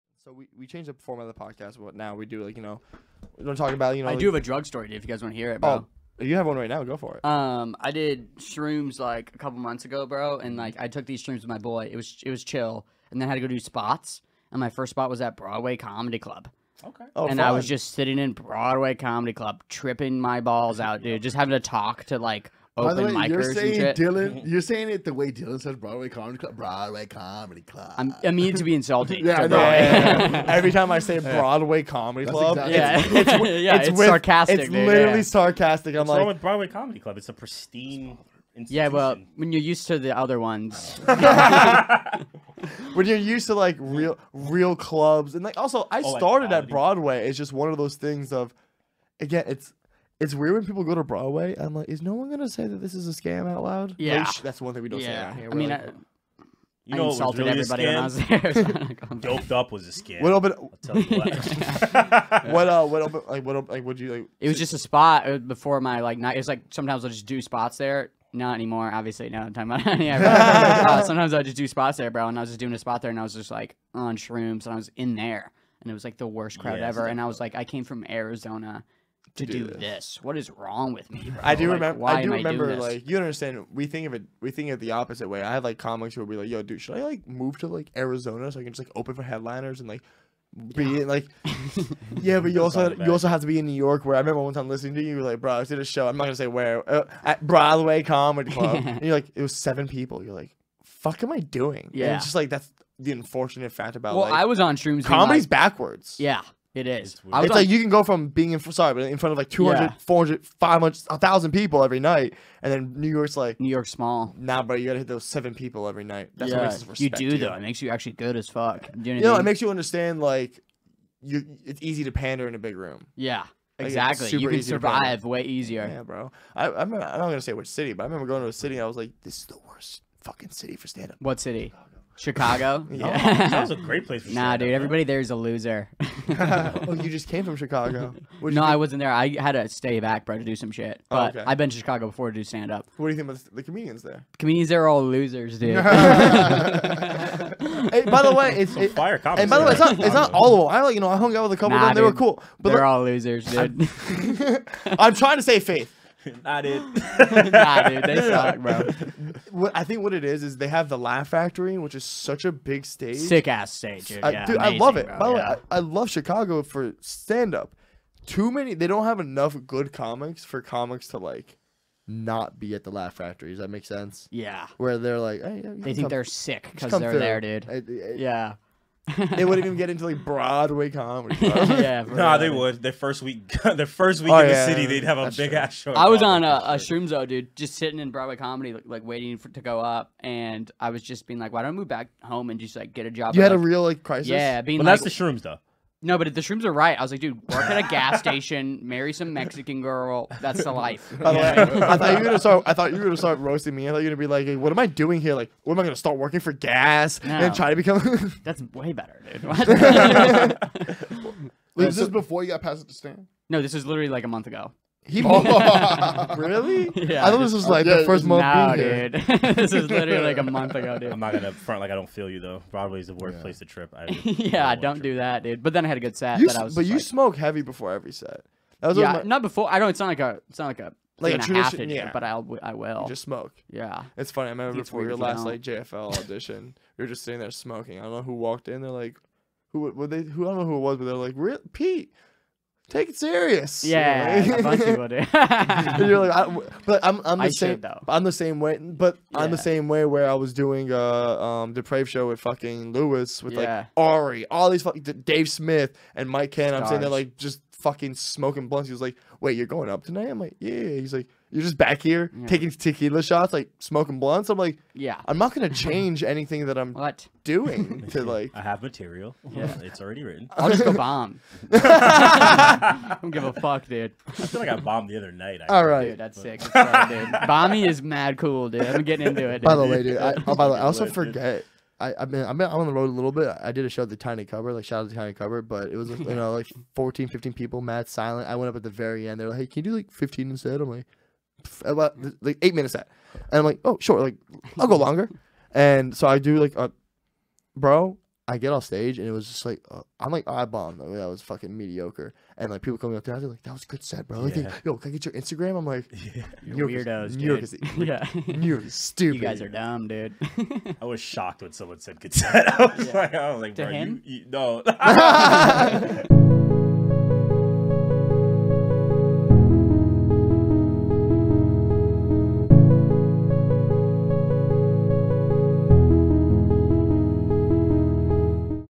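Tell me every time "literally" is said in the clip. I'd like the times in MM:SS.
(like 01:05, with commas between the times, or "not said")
00:34, 03:33, 03:39.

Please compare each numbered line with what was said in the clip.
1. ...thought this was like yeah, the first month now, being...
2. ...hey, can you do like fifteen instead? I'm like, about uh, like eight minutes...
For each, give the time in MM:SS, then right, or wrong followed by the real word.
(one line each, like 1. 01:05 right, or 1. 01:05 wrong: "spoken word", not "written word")
1. 03:37 right
2. 04:49 right.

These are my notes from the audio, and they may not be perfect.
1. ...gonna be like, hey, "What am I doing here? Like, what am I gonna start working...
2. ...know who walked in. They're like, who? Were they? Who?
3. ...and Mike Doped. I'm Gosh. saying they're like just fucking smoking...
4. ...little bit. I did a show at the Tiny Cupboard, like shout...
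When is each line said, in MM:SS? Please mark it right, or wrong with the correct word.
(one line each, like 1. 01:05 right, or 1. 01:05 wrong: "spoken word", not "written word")
1. 03:24 right
2. 03:58 right
3. 04:16 wrong: "Ken", not "Doped"
4. 04:43 right.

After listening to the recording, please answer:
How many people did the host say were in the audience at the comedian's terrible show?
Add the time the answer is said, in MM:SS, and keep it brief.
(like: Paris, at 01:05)
7, at 01:39.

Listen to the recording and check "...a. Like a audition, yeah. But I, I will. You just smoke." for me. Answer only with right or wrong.
wrong.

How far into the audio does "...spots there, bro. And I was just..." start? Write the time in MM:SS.
01:11.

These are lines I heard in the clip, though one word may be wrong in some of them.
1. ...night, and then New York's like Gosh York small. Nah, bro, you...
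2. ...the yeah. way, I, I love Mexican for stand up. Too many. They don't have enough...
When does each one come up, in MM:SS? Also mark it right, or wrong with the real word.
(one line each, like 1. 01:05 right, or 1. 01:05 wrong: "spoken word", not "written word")
1. 01:51 wrong: "New", not "Gosh"
2. 02:45 wrong: "Chicago", not "Mexican".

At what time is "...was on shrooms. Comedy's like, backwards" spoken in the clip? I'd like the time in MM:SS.
01:44.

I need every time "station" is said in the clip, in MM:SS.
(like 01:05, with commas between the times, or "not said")
03:18.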